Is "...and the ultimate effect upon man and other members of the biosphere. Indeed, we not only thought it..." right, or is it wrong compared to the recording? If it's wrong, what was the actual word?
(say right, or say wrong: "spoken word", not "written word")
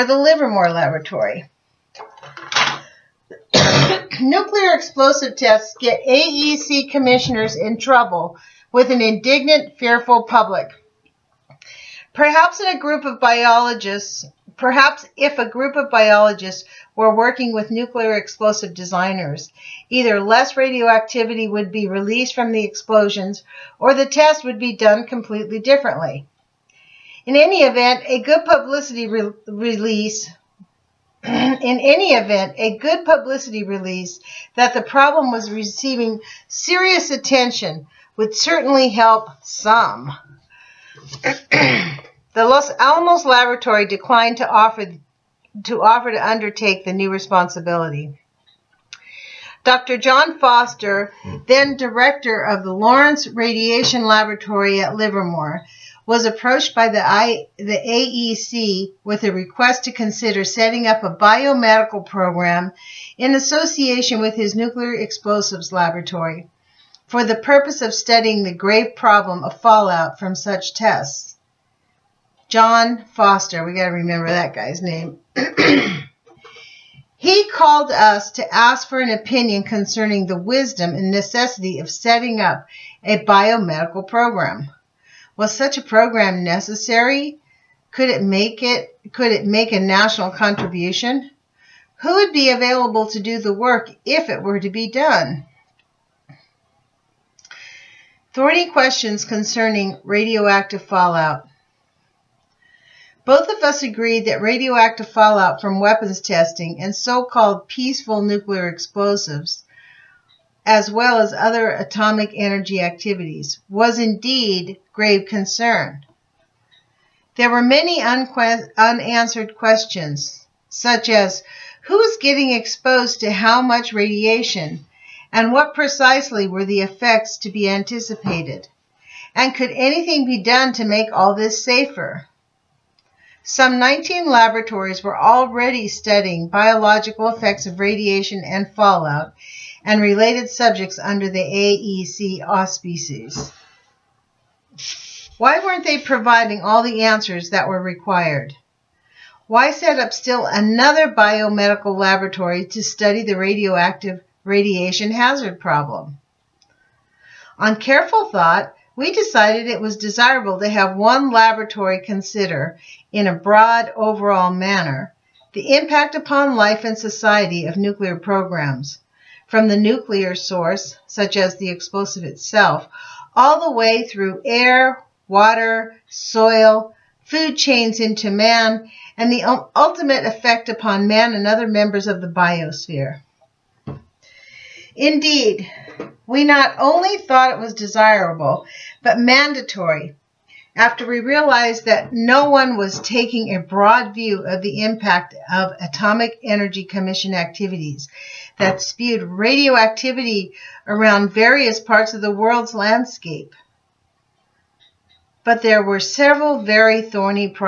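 right.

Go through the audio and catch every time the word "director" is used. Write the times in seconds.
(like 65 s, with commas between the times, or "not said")
51 s.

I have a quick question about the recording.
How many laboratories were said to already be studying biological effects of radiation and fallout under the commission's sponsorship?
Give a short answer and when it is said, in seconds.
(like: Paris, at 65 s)
19, at 133 s.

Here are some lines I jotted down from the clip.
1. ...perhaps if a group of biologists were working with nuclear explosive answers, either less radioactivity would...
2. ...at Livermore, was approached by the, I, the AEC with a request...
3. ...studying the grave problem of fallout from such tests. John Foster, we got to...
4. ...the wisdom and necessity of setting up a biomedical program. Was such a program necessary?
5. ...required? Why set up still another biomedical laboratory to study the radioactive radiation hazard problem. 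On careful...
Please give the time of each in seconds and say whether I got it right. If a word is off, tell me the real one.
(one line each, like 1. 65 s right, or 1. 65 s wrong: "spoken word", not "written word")
1. 14 s wrong: "designers", not "answers"
2. 54 s right
3. 67 s right
4. 80 s right
5. 147 s right.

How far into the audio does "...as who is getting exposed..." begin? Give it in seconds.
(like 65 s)
121 s.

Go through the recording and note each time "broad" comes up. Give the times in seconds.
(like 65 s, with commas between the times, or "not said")
163 s, 193 s.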